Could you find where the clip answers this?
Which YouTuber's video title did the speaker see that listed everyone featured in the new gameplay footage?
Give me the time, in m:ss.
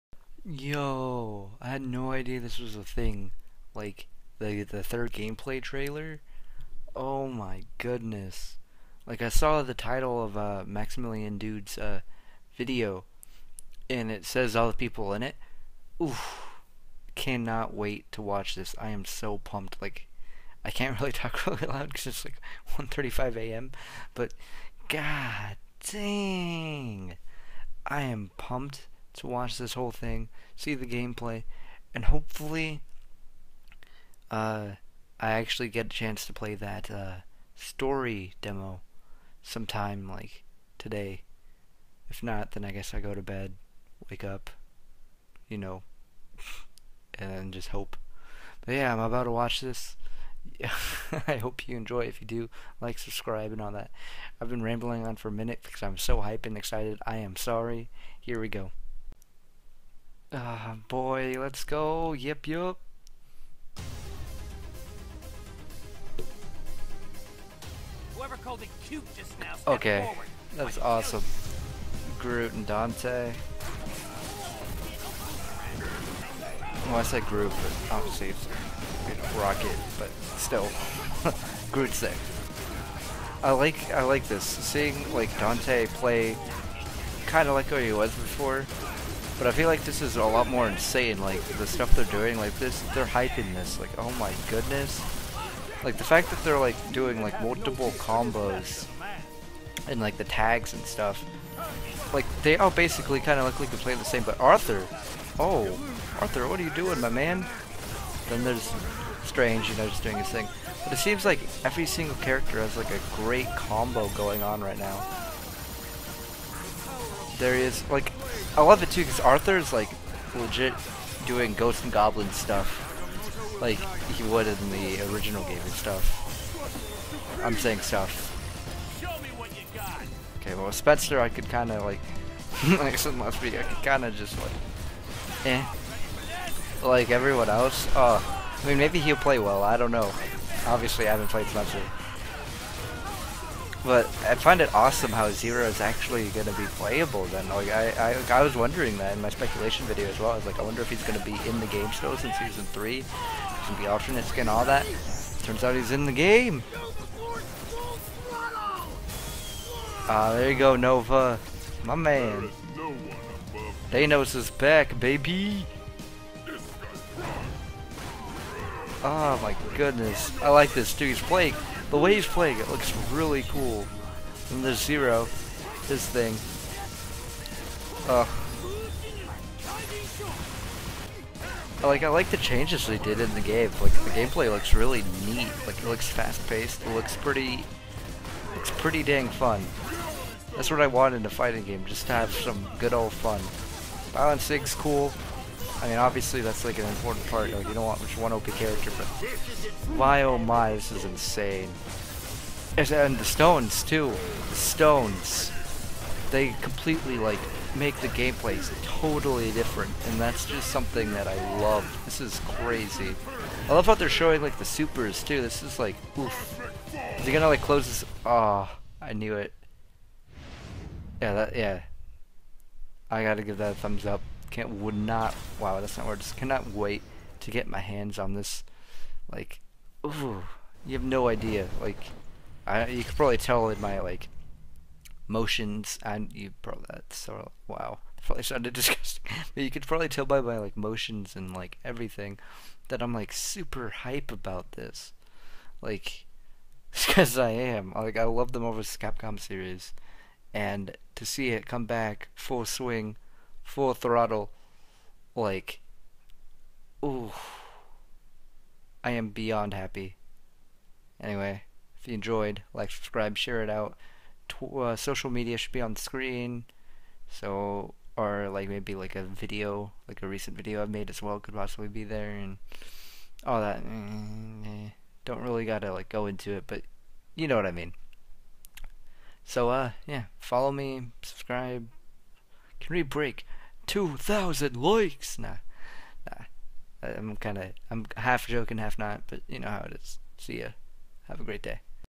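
0:10.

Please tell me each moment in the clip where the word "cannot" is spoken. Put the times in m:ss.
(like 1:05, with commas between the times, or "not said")
0:17, 3:46.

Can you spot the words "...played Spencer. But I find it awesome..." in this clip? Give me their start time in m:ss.
2:21.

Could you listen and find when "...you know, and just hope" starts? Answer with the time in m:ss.
0:45.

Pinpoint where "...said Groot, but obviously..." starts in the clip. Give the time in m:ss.
1:17.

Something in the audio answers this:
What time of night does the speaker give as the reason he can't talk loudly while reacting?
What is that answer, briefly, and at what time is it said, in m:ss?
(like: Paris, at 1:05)
1:35 a.m., at 0:22.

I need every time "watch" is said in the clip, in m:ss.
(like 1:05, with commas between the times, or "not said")
0:18, 0:29, 0:49.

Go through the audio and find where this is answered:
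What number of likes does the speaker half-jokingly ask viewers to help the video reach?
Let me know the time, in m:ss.
4:43.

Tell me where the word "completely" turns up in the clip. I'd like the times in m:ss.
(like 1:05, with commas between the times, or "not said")
3:26.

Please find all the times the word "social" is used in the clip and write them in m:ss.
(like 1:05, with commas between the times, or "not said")
4:24.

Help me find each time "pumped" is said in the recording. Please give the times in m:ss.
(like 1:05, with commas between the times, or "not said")
0:19, 0:28.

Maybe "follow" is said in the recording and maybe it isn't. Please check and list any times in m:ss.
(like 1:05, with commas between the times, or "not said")
4:40.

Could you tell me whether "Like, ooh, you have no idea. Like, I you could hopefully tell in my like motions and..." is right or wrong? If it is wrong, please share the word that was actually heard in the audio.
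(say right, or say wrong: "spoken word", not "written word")
wrong: "probably", not "hopefully".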